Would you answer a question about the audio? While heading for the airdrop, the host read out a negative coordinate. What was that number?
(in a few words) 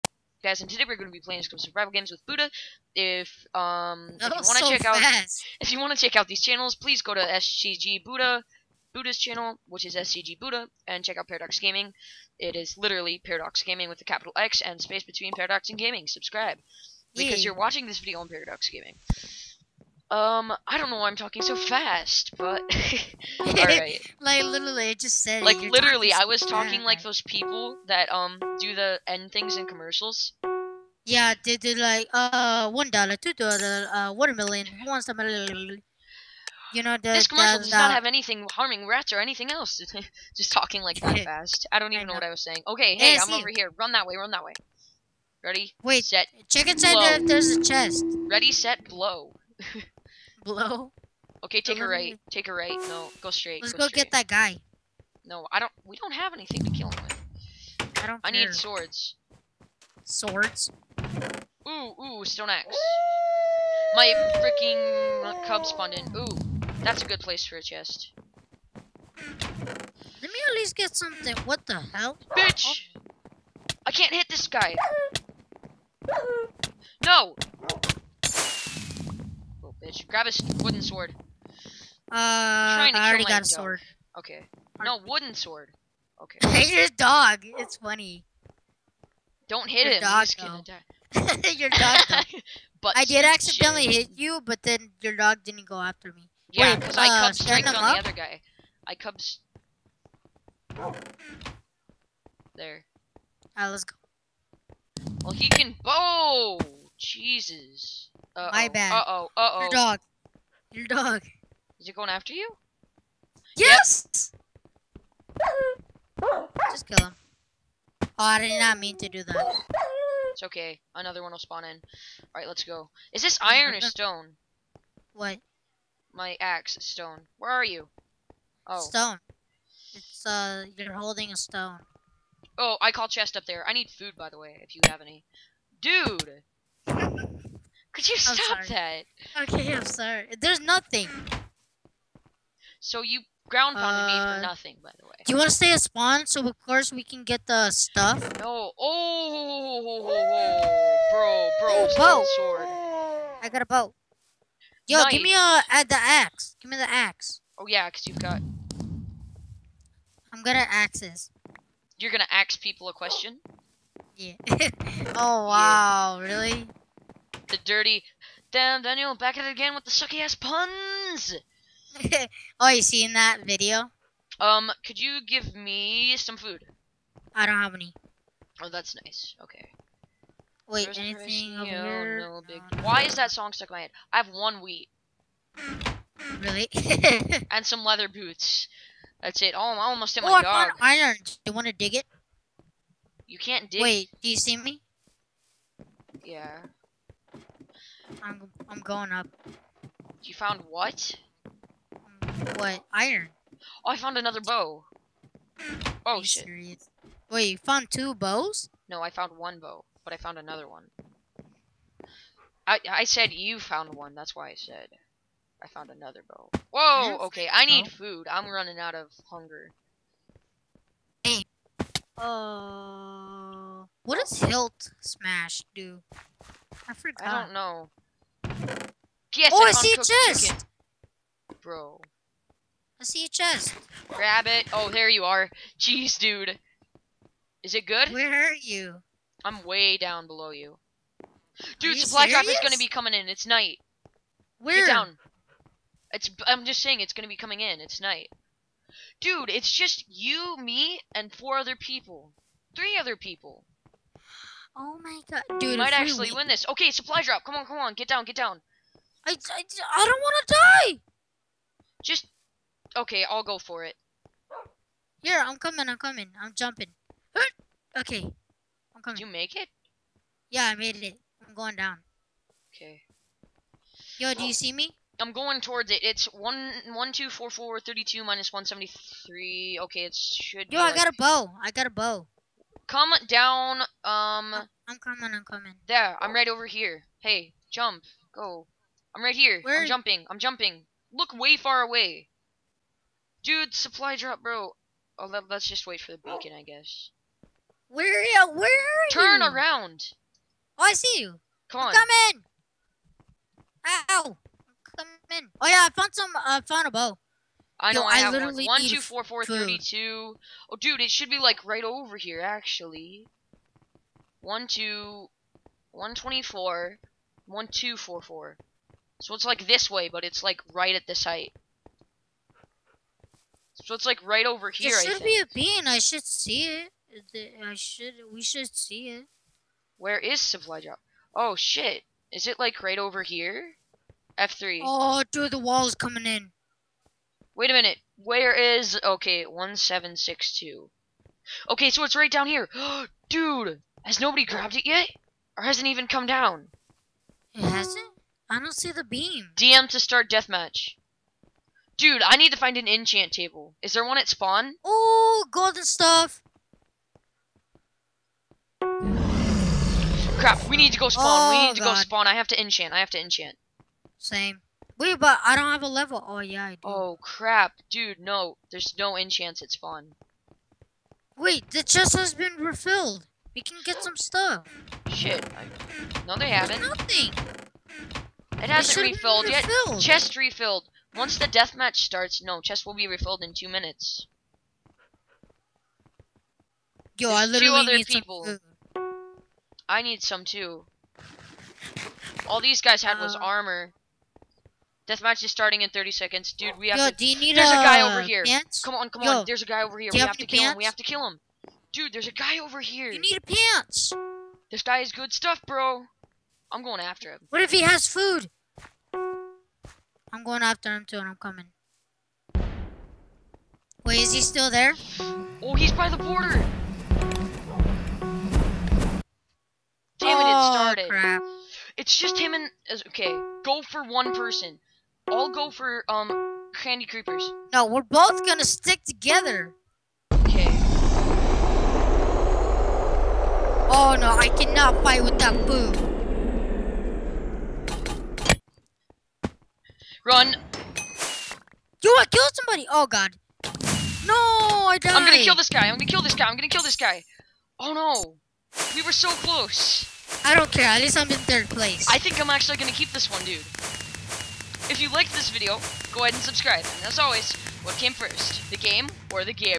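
-173.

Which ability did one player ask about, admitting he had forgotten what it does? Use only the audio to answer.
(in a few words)
hilt smash.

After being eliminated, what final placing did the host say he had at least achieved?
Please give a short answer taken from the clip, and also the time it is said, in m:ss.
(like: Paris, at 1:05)
third place, at 7:31.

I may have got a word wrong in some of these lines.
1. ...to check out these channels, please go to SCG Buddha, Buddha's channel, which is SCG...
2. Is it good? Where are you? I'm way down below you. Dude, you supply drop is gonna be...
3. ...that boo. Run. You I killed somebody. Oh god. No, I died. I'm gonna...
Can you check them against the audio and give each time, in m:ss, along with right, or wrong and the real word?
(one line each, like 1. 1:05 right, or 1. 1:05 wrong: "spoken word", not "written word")
1. 0:05 right
2. 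3:57 right
3. 7:15 right.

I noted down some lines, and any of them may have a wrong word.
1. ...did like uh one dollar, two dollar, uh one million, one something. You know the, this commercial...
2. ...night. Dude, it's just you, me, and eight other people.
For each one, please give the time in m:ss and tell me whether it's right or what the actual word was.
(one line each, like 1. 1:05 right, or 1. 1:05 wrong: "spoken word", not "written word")
1. 0:31 right
2. 4:08 wrong: "four", not "eight".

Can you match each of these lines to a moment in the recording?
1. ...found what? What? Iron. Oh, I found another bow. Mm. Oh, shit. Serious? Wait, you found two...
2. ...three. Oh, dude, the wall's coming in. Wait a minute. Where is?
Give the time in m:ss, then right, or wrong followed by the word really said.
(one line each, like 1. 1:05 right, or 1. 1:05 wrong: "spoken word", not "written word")
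1. 3:20 right
2. 5:34 right.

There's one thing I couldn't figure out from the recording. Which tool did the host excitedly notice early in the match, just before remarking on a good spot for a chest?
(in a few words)
stone axe.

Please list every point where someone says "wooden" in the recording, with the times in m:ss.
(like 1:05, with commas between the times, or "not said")
1:20, 1:25.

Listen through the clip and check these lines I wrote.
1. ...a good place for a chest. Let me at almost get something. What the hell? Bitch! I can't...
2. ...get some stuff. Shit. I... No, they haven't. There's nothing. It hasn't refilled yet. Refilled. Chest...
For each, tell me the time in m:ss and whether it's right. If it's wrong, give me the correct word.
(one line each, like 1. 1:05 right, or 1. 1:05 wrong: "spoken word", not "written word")
1. 1:07 wrong: "least", not "almost"
2. 6:13 right.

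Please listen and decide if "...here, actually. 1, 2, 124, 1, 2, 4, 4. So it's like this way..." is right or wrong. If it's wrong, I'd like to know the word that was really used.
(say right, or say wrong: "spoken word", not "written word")
right.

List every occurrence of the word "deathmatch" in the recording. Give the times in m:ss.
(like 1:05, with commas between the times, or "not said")
5:50, 6:21, 6:35.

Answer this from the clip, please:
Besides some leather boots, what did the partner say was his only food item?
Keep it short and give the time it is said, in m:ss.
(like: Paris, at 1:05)
one wheat, at 3:04.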